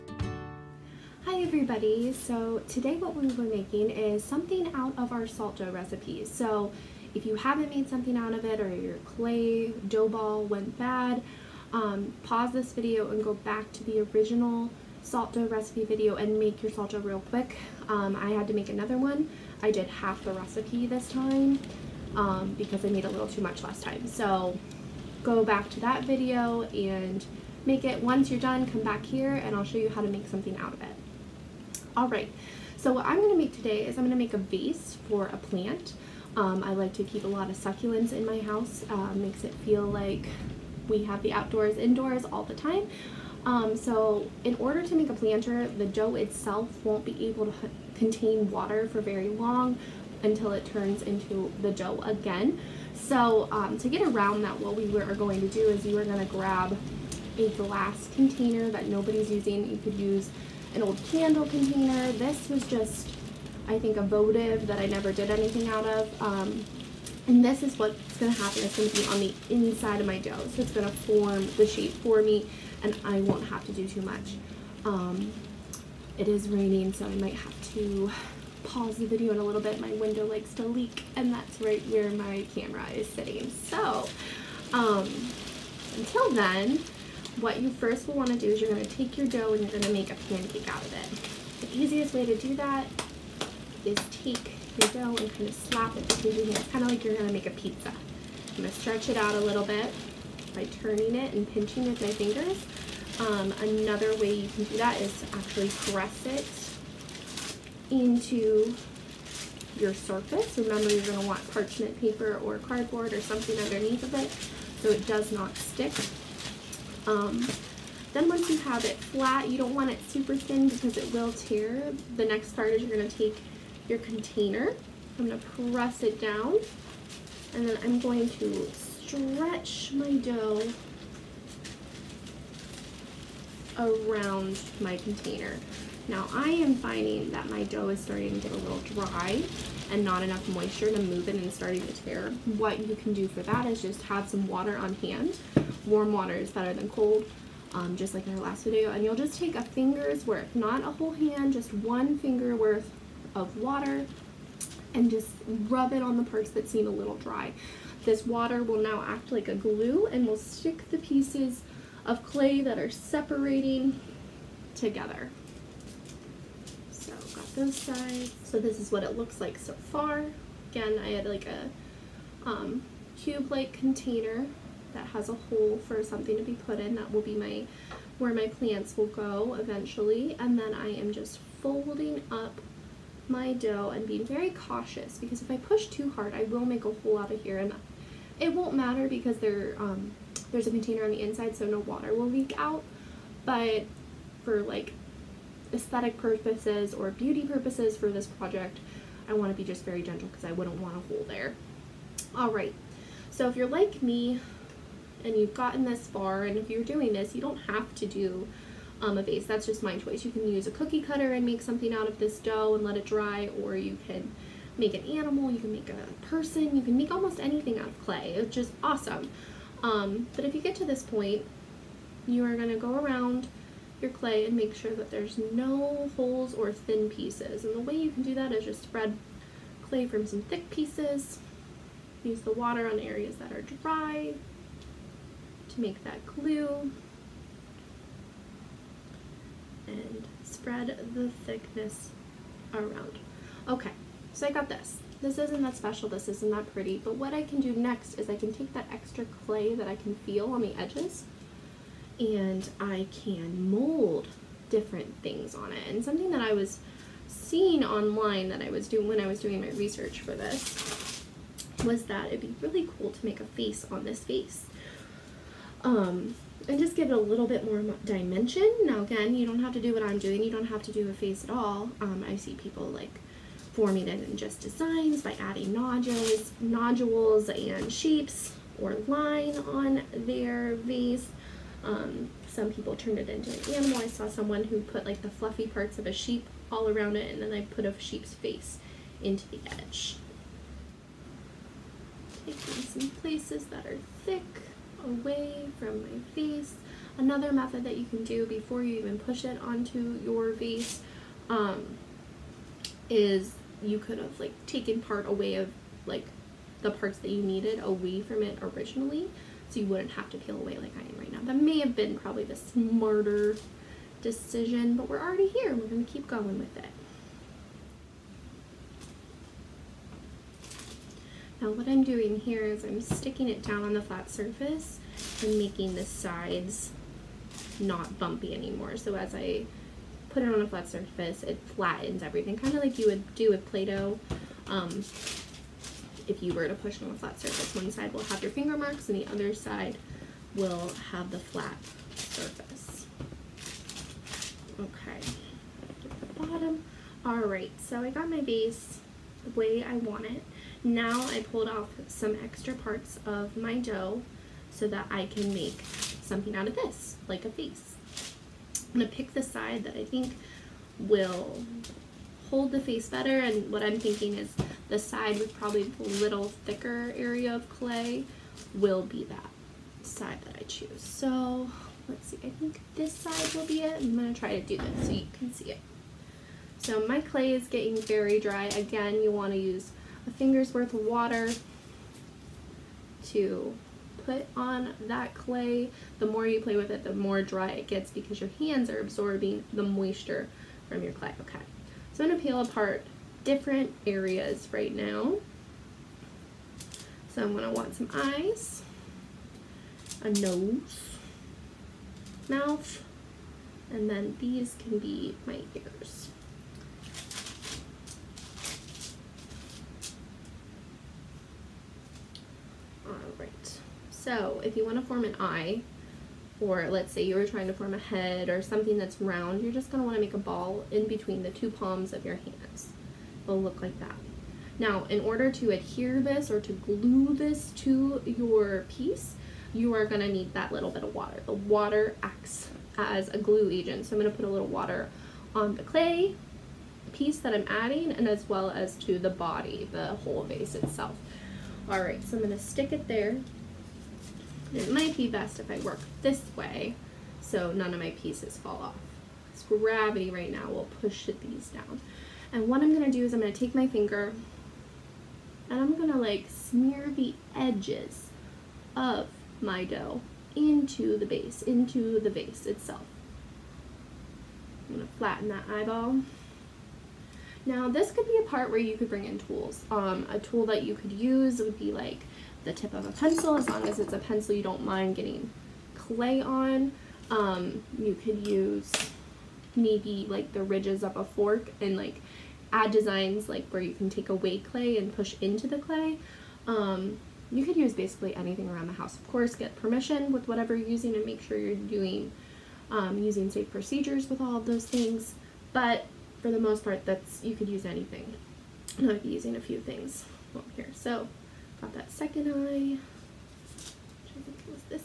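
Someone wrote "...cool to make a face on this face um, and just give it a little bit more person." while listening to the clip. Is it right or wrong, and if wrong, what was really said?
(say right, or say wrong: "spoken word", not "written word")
wrong: "dimension", not "person".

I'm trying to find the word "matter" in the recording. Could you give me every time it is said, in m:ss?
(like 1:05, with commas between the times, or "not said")
3:08.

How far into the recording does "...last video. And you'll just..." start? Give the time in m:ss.
2:28.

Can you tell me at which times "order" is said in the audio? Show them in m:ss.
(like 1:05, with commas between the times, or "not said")
0:44, 7:05.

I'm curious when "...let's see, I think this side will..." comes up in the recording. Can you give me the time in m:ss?
6:12.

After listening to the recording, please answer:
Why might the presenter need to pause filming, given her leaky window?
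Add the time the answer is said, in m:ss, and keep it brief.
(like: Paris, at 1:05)
It is raining, at 1:16.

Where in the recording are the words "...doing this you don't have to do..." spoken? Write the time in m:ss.
3:26.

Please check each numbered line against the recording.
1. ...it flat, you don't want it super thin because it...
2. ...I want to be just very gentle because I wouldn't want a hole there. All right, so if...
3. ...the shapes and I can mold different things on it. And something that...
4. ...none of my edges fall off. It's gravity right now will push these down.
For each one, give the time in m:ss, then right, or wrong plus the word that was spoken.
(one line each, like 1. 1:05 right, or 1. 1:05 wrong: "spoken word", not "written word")
1. 1:58 right
2. 3:19 right
3. 4:10 wrong: "edges", not "shapes"
4. 7:27 wrong: "pieces", not "edges".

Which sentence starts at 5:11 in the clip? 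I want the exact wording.
That may have been probably the smarter decision, but we're already here.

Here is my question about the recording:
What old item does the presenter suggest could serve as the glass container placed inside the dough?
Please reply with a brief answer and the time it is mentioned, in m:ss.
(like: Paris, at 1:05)
An old candle container, at 1:00.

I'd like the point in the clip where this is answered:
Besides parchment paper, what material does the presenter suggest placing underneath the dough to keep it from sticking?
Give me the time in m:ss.
1:52.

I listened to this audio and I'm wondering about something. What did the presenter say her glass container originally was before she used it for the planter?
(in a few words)
A votive.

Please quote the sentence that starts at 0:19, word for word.
I did half the recipe this time um, because I made a little too much last time.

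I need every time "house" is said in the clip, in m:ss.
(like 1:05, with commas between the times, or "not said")
0:38, 8:08.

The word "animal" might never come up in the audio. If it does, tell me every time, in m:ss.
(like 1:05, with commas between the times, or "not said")
3:35, 4:43.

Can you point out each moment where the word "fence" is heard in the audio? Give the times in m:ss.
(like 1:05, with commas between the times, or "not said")
not said.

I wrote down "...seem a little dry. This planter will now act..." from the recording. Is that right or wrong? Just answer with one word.
wrong.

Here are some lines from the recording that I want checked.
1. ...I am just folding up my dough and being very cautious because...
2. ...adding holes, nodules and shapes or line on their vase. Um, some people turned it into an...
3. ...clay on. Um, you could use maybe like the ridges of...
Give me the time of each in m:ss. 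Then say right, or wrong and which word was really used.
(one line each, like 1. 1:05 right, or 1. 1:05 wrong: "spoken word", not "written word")
1. 3:00 right
2. 4:35 wrong: "nodules", not "holes"
3. 7:55 right.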